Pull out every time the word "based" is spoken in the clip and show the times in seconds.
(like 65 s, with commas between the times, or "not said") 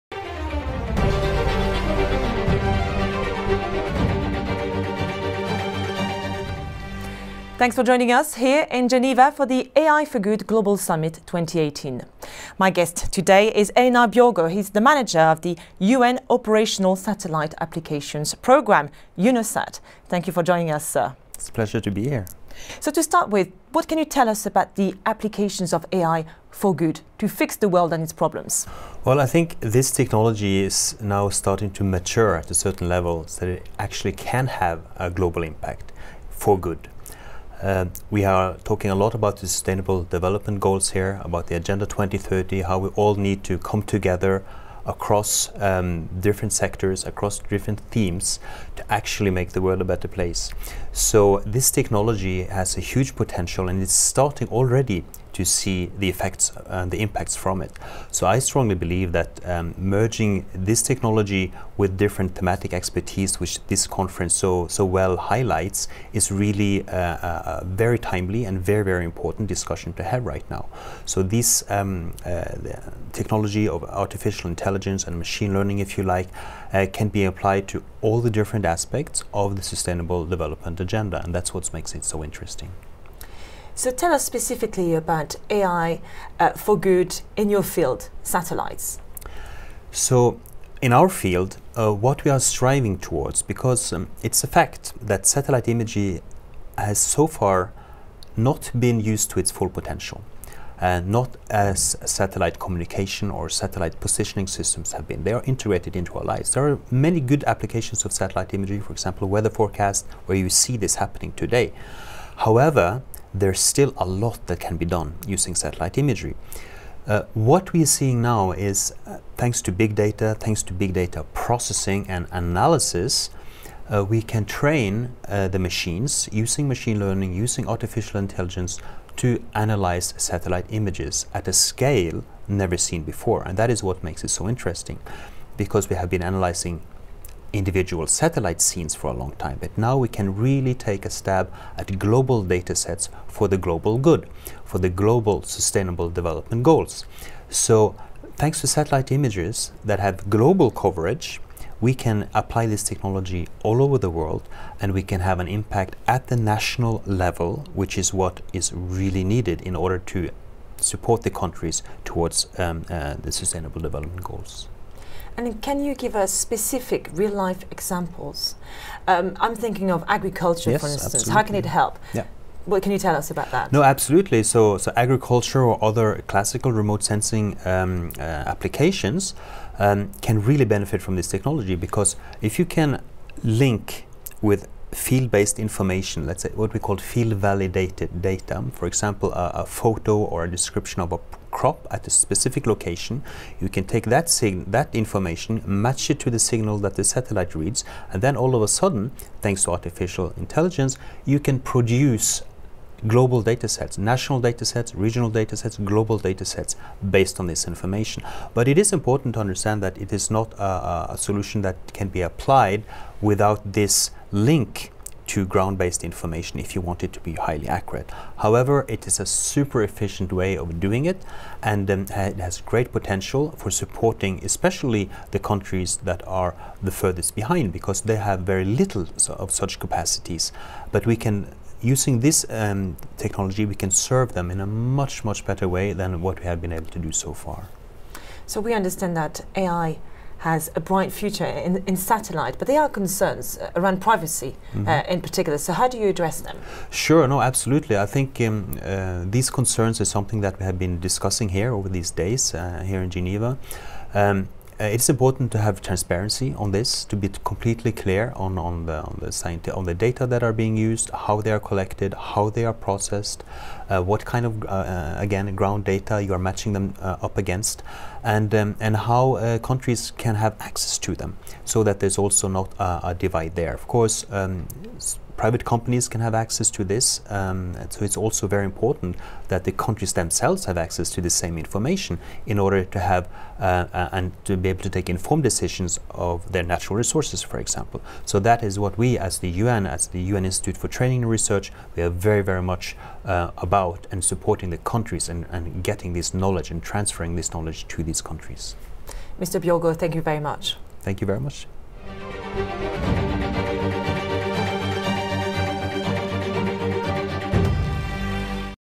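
184 s, 207 s, 215 s.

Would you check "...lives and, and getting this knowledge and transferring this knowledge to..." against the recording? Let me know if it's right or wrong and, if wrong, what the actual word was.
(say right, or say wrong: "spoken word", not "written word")
wrong: "countries", not "lives".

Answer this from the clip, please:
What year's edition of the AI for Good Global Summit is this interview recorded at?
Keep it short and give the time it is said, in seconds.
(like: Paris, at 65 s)
2018, at 11 s.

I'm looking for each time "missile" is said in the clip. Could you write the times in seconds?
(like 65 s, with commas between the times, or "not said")
not said.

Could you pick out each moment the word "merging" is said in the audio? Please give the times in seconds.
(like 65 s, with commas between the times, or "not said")
59 s.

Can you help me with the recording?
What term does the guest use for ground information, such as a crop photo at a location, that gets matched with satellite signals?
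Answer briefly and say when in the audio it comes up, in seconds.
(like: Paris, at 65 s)
Field-validated data, at 186 s.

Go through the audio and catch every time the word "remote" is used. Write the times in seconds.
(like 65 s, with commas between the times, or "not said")
176 s.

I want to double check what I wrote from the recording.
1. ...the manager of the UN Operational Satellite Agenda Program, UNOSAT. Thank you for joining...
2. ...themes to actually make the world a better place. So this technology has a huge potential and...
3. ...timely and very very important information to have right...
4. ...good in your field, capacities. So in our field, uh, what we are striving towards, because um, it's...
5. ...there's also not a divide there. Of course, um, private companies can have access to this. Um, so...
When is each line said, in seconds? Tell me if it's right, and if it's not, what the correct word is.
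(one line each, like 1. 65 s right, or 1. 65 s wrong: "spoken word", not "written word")
1. 14 s wrong: "Applications", not "Agenda"
2. 47 s right
3. 67 s wrong: "discussion", not "information"
4. 86 s wrong: "satellites", not "capacities"
5. 271 s right.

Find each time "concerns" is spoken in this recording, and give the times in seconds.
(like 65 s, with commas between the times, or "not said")
242 s, 249 s.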